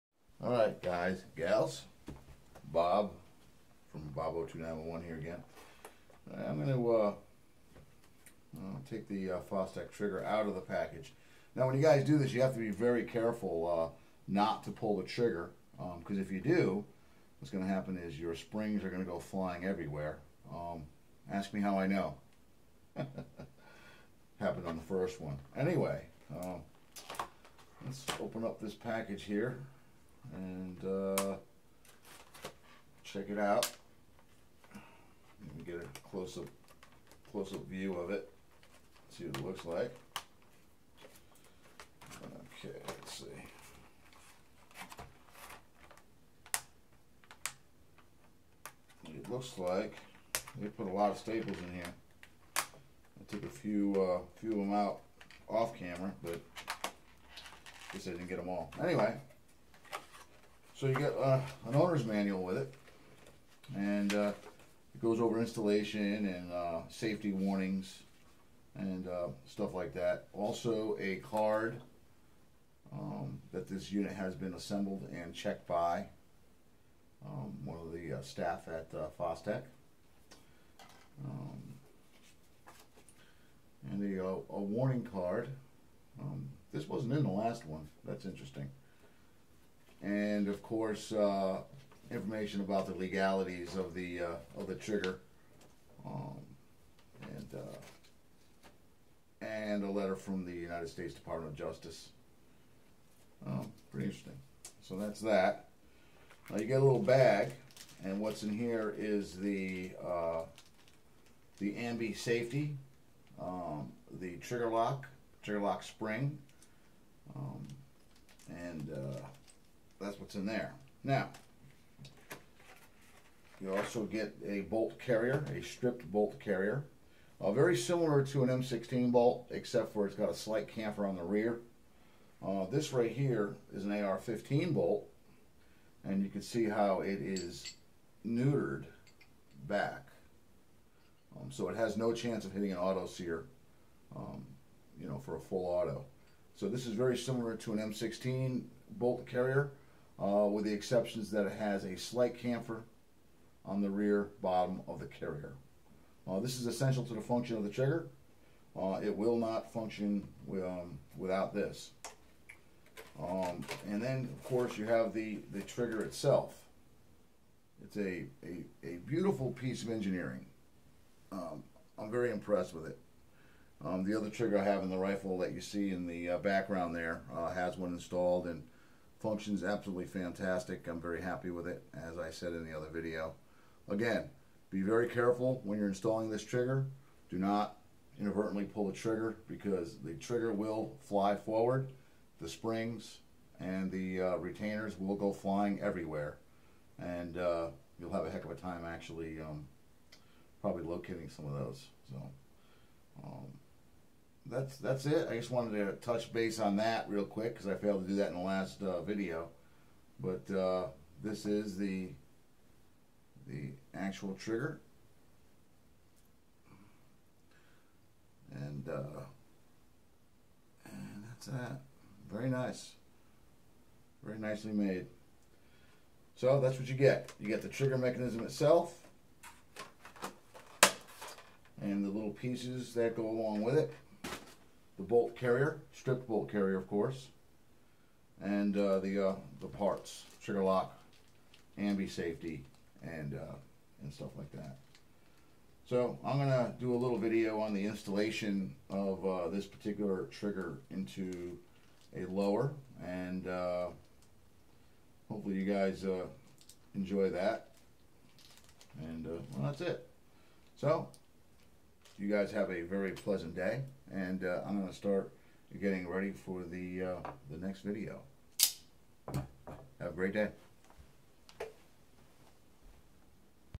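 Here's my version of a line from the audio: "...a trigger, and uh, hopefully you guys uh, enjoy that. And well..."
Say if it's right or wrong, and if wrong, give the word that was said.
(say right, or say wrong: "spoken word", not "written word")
wrong: "lower", not "trigger".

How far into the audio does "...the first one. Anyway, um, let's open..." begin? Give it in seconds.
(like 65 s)
24 s.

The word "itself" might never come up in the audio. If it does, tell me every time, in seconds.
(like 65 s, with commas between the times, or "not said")
166 s, 228 s.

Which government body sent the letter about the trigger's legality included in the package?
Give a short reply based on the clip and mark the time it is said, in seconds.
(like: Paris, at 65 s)
United States Department of Justice, at 100 s.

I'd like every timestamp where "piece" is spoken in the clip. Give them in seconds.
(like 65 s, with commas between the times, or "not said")
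169 s, 232 s.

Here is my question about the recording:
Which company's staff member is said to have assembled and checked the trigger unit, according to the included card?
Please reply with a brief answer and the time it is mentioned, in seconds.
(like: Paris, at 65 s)
Fostech, at 79 s.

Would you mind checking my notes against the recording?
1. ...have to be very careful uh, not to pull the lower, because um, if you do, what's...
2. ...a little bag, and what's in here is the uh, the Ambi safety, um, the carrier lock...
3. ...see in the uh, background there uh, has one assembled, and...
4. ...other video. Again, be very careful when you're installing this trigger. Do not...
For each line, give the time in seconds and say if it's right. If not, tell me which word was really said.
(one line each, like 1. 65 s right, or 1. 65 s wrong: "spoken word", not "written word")
1. 12 s wrong: "trigger", not "lower"
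2. 106 s wrong: "trigger", not "carrier"
3. 175 s wrong: "installed", not "assembled"
4. 182 s right.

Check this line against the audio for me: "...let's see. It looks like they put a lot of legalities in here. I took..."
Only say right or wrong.
wrong.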